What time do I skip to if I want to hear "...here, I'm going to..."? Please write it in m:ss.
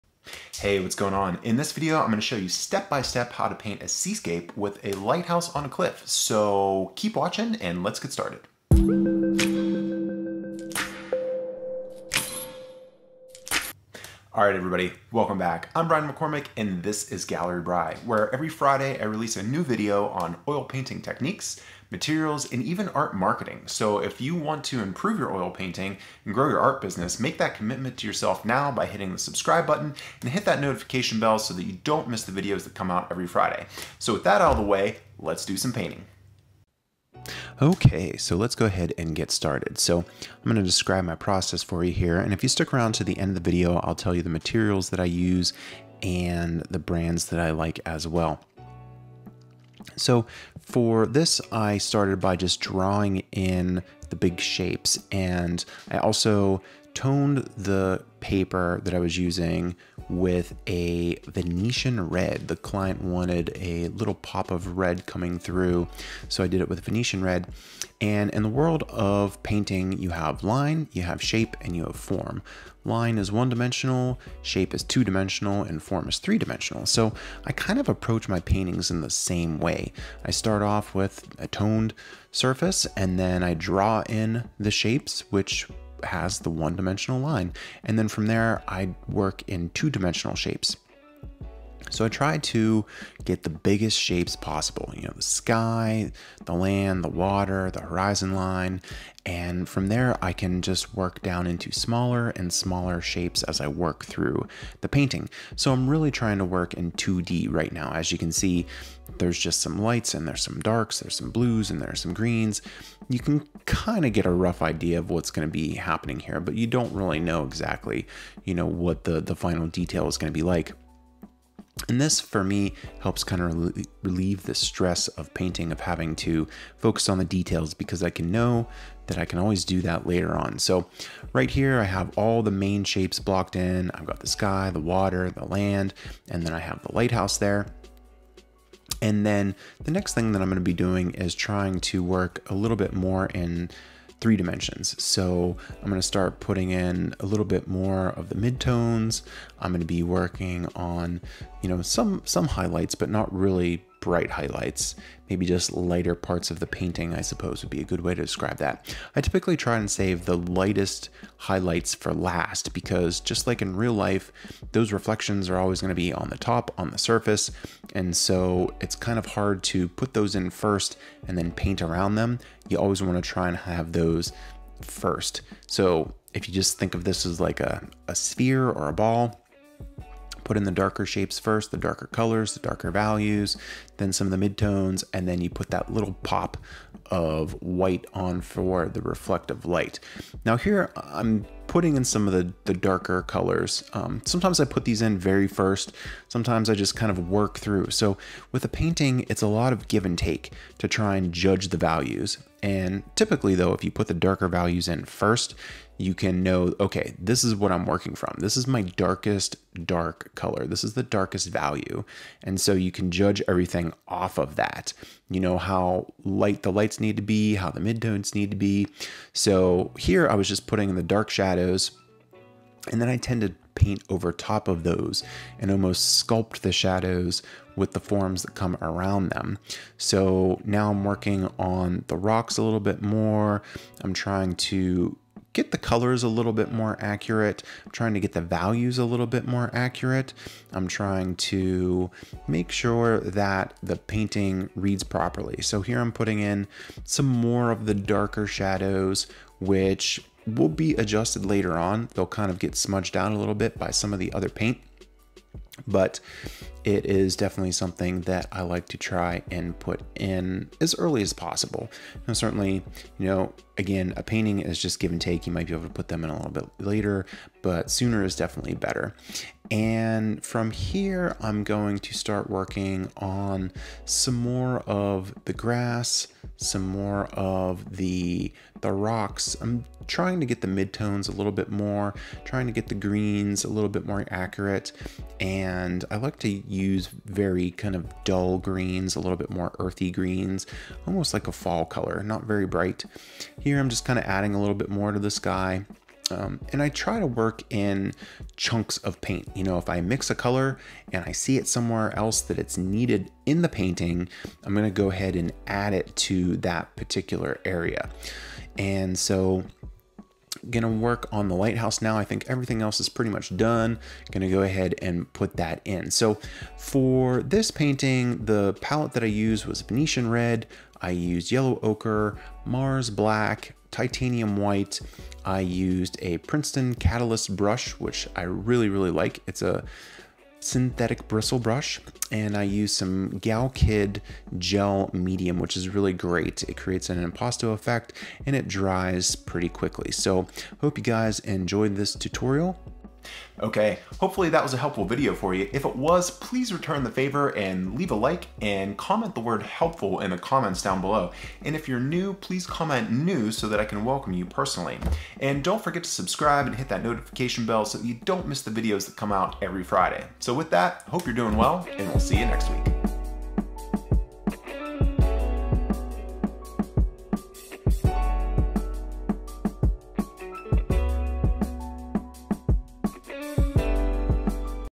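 4:30.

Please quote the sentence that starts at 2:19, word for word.
And then the next thing that I'm gonna be doing is trying to work a little bit more in three dimensions.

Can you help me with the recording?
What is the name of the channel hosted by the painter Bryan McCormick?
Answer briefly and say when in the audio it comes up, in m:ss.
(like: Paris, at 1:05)
Gallery Bry, at 0:17.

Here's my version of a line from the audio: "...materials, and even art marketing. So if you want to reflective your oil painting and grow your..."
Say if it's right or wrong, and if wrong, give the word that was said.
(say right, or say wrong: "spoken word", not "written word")
wrong: "improve", not "reflective".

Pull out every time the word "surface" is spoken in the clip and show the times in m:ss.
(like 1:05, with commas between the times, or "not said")
1:22, 2:46.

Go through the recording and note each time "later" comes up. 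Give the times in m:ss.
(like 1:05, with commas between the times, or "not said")
2:10, 4:11, 4:26.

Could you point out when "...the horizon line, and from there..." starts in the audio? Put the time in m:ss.
1:37.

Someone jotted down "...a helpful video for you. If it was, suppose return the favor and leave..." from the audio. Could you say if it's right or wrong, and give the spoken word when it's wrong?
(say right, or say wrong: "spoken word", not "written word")
wrong: "please", not "suppose".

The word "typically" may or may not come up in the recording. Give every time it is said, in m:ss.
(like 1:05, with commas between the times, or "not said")
2:39, 3:23.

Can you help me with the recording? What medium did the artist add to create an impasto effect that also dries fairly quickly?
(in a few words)
Galkyd gel medium.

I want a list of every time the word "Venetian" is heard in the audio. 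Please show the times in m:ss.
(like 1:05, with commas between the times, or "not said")
1:01, 1:06, 5:19.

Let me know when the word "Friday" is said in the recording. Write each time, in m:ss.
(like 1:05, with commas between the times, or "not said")
0:18, 0:33, 5:59.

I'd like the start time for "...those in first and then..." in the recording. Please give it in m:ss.
2:50.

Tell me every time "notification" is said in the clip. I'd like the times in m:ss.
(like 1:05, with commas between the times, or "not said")
0:30, 5:57.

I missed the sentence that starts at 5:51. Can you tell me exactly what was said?
And if you're new, please comment new so that I can welcome you personally.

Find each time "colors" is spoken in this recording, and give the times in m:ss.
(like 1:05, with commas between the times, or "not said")
3:02, 3:13, 3:30, 3:55, 4:51, 5:00.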